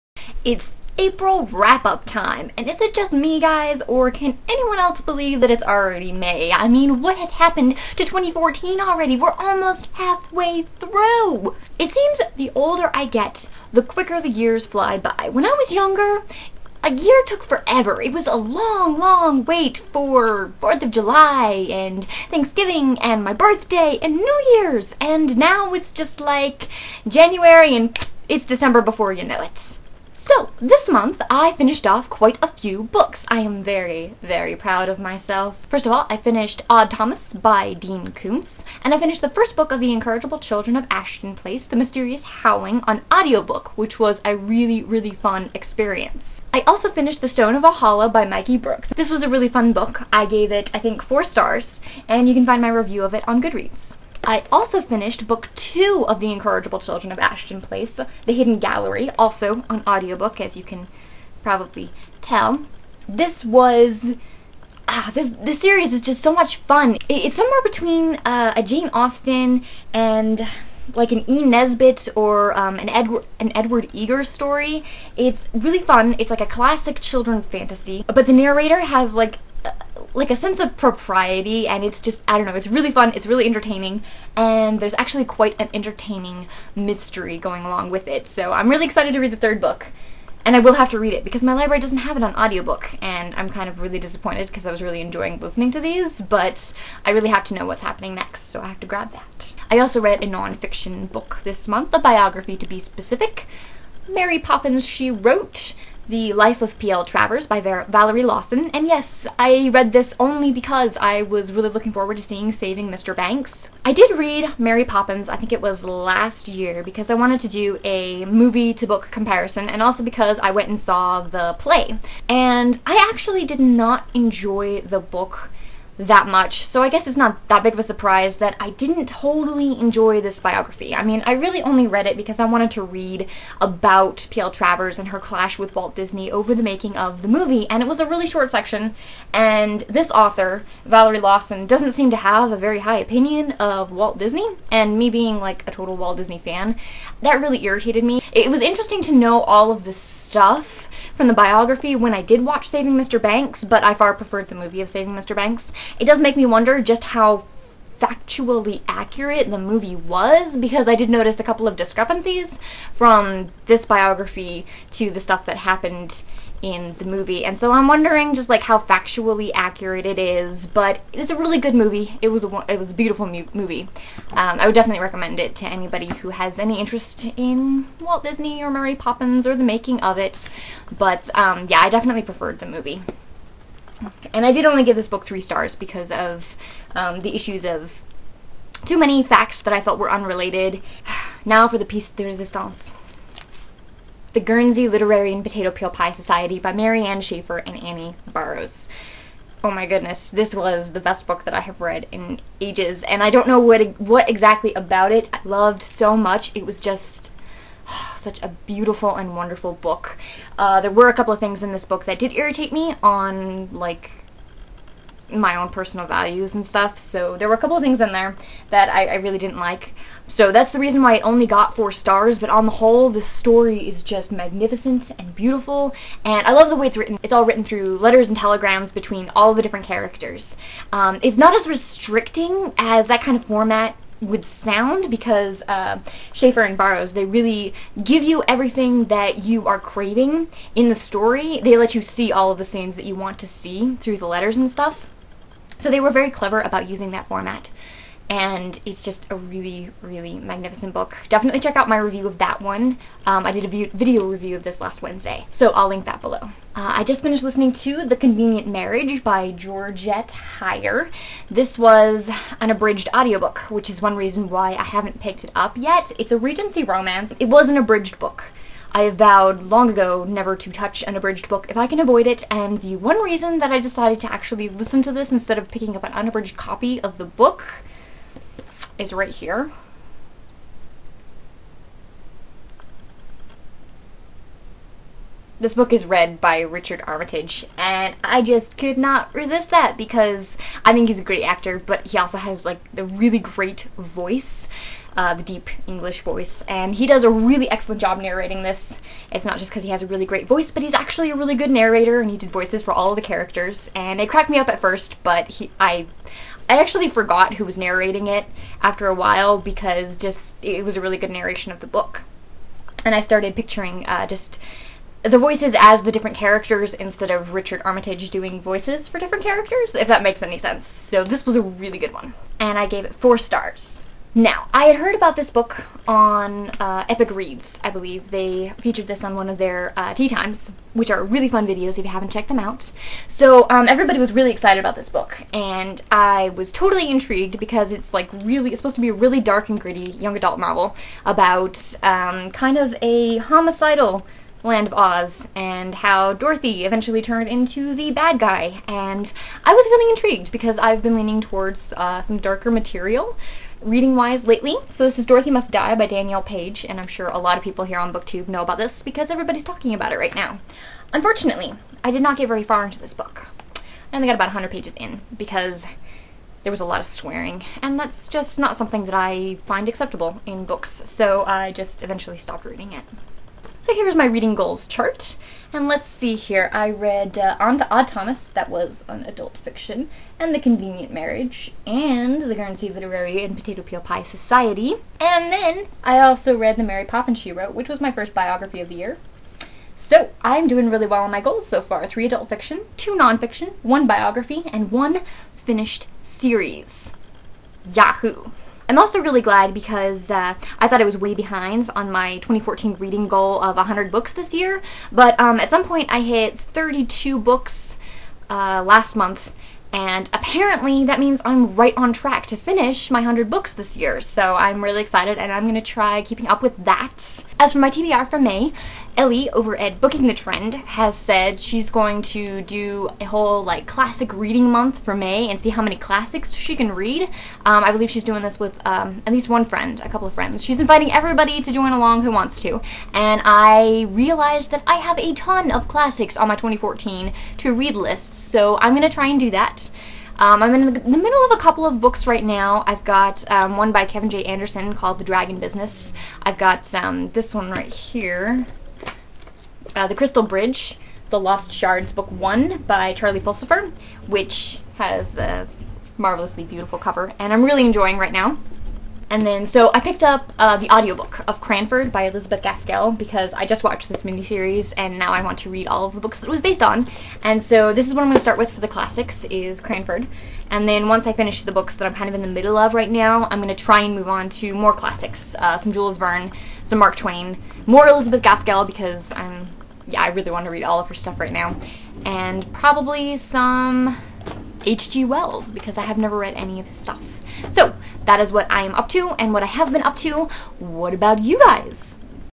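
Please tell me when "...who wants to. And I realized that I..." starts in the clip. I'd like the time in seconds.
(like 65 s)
432 s.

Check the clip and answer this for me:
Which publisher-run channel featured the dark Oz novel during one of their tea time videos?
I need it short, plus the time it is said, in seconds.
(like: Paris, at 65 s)
Epic Reads, at 327 s.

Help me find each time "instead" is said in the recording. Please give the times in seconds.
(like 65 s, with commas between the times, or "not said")
275 s, 316 s.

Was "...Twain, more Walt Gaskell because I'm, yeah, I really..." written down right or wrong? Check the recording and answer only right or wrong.
wrong.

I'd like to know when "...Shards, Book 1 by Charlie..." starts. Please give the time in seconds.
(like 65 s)
451 s.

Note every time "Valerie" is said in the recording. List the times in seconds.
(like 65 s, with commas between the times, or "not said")
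107 s, 140 s.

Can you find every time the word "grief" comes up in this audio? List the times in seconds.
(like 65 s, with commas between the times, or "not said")
not said.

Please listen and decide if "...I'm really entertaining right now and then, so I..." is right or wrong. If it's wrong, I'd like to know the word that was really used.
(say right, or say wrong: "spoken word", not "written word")
wrong: "enjoying", not "entertaining".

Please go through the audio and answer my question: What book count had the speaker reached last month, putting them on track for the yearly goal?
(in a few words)
32.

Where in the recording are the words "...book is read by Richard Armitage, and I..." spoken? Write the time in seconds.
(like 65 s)
285 s.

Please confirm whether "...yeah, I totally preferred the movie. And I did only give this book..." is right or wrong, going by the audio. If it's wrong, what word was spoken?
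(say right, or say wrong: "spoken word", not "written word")
wrong: "definitely", not "totally".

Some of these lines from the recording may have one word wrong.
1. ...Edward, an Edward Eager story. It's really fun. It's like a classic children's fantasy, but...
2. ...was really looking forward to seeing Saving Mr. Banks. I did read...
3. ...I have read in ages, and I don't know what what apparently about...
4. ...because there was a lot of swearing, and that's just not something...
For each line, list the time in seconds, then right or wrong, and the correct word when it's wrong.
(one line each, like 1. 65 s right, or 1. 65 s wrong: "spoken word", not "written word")
1. 72 s right
2. 111 s right
3. 201 s wrong: "exactly", not "apparently"
4. 365 s right.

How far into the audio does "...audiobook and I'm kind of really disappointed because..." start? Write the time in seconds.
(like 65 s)
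92 s.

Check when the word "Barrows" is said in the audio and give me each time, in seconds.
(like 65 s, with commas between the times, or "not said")
198 s, 236 s.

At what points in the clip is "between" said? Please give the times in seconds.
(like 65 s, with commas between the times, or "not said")
67 s, 228 s.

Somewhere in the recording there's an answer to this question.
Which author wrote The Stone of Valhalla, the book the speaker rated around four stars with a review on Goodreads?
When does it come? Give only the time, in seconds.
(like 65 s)
48 s.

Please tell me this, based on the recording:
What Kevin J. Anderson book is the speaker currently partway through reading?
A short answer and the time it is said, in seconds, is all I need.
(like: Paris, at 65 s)
The Dragon Business, at 445 s.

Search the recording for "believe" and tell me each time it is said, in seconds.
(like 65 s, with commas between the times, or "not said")
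4 s, 327 s, 427 s.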